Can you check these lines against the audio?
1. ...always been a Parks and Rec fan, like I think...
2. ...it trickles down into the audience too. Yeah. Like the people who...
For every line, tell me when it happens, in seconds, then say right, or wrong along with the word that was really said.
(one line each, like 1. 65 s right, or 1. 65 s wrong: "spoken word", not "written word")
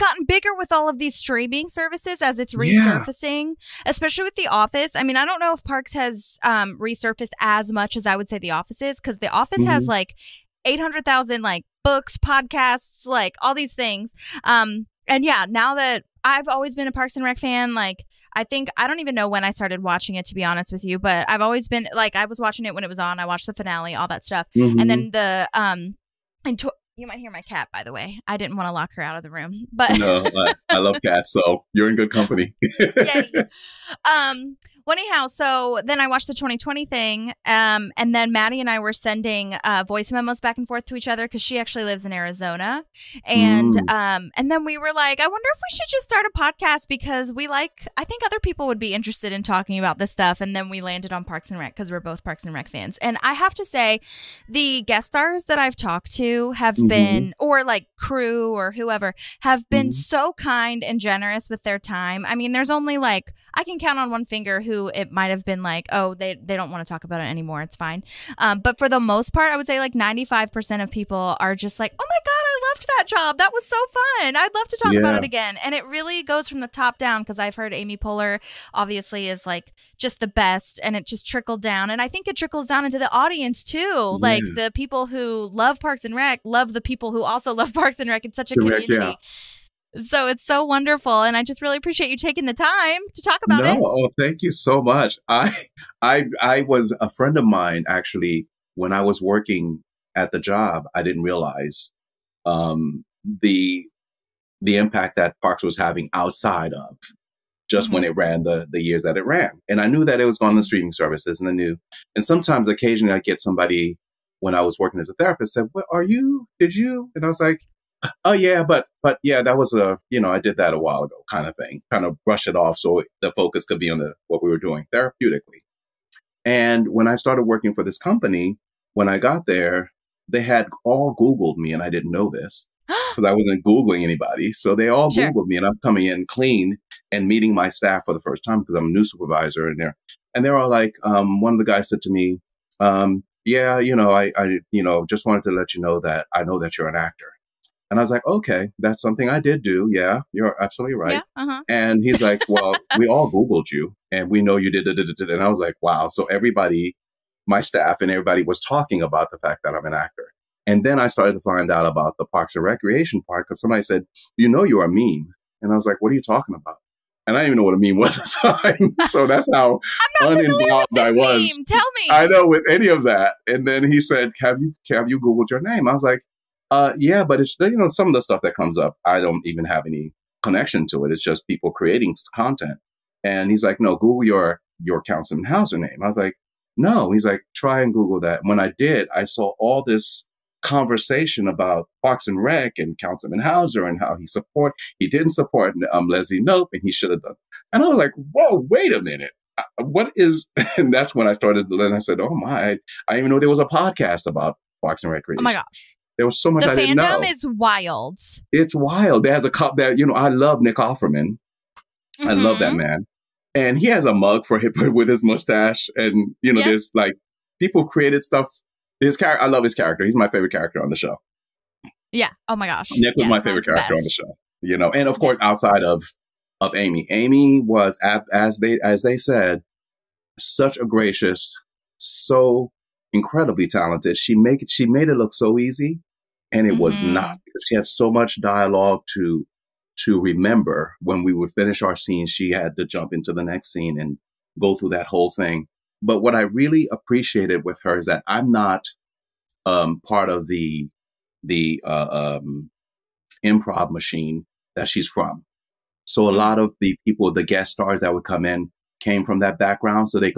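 1. 16 s right
2. 82 s right.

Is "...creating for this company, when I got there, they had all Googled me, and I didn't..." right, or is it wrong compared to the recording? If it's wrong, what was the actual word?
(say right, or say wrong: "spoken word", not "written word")
wrong: "working", not "creating".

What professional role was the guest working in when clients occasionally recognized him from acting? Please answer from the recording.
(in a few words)
therapist.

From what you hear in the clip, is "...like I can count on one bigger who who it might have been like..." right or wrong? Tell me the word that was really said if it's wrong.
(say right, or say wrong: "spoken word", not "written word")
wrong: "finger", not "bigger".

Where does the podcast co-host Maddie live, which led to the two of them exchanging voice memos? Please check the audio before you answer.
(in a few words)
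Arizona.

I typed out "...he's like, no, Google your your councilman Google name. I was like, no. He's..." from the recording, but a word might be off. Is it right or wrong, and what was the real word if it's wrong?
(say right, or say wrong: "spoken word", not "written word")
wrong: "Howser", not "Google".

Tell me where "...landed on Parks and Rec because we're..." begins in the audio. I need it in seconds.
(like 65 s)
50 s.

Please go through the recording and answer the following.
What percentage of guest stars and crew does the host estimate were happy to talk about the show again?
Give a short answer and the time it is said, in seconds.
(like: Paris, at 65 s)
95%, at 69 s.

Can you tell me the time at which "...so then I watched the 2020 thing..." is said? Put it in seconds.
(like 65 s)
35 s.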